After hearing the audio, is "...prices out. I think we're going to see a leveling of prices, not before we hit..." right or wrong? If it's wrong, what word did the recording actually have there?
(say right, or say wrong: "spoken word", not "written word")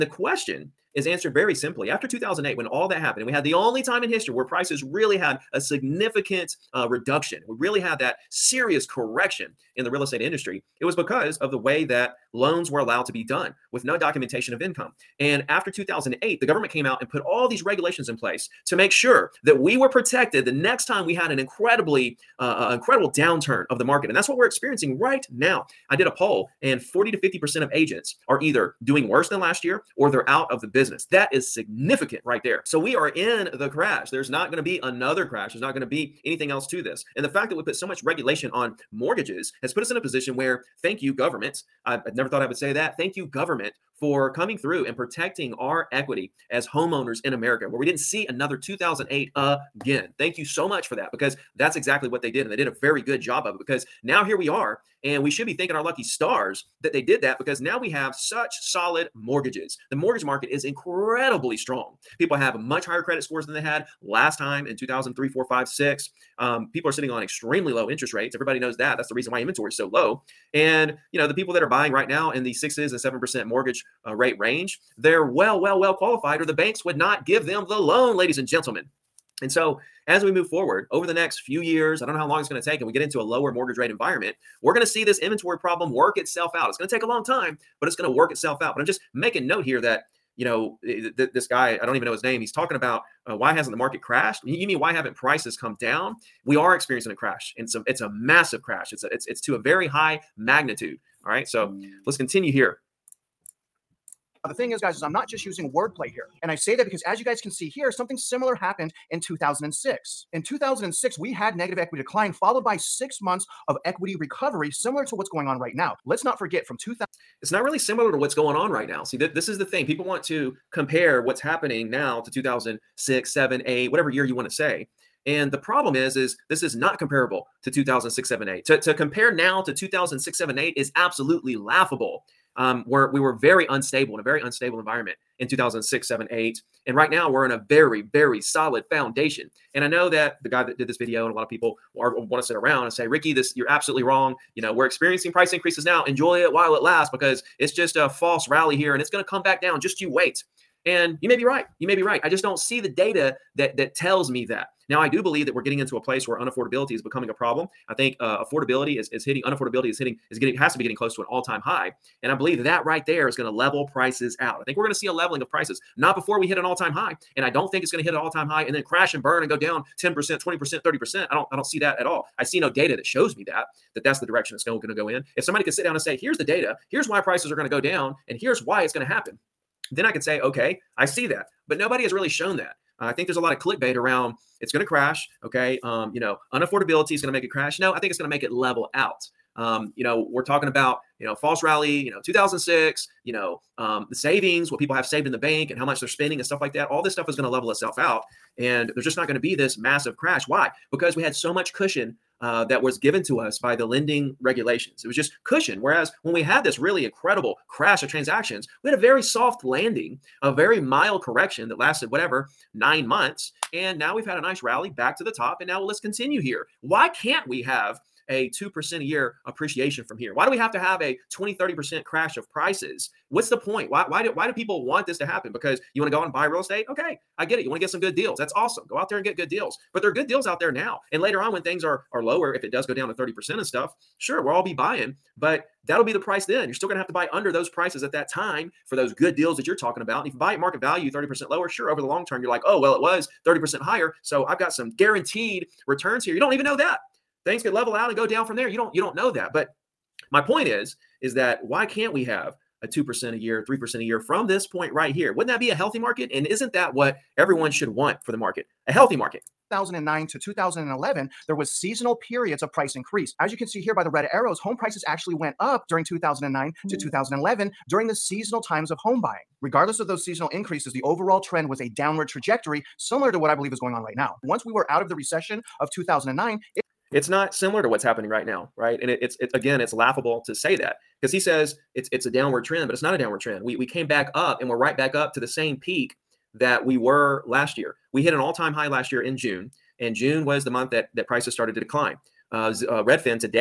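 right.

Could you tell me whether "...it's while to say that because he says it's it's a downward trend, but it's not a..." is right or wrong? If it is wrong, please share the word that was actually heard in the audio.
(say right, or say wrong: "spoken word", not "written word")
wrong: "laughable", not "while".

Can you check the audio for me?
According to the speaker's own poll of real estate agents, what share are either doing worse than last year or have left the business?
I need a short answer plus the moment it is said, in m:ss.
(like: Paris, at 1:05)
40 to 50%, at 0:26.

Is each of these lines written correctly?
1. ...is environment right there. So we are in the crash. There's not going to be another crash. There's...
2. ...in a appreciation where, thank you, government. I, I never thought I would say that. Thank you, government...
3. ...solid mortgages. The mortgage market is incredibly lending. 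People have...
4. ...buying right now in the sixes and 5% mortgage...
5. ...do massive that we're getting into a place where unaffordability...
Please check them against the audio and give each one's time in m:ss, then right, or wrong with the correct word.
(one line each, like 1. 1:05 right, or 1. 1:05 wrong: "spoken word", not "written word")
1. 0:31 wrong: "significant", not "environment"
2. 0:39 wrong: "position", not "appreciation"
3. 0:58 wrong: "strong", not "lending"
4. 1:11 wrong: "7", not "5"
5. 2:35 wrong: "believe", not "massive".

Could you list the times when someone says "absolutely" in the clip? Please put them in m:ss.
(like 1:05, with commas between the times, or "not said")
2:10, 2:23.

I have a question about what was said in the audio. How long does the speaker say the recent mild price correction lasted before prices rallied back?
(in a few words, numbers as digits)
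9 months.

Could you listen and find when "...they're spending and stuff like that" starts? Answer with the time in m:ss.
3:16.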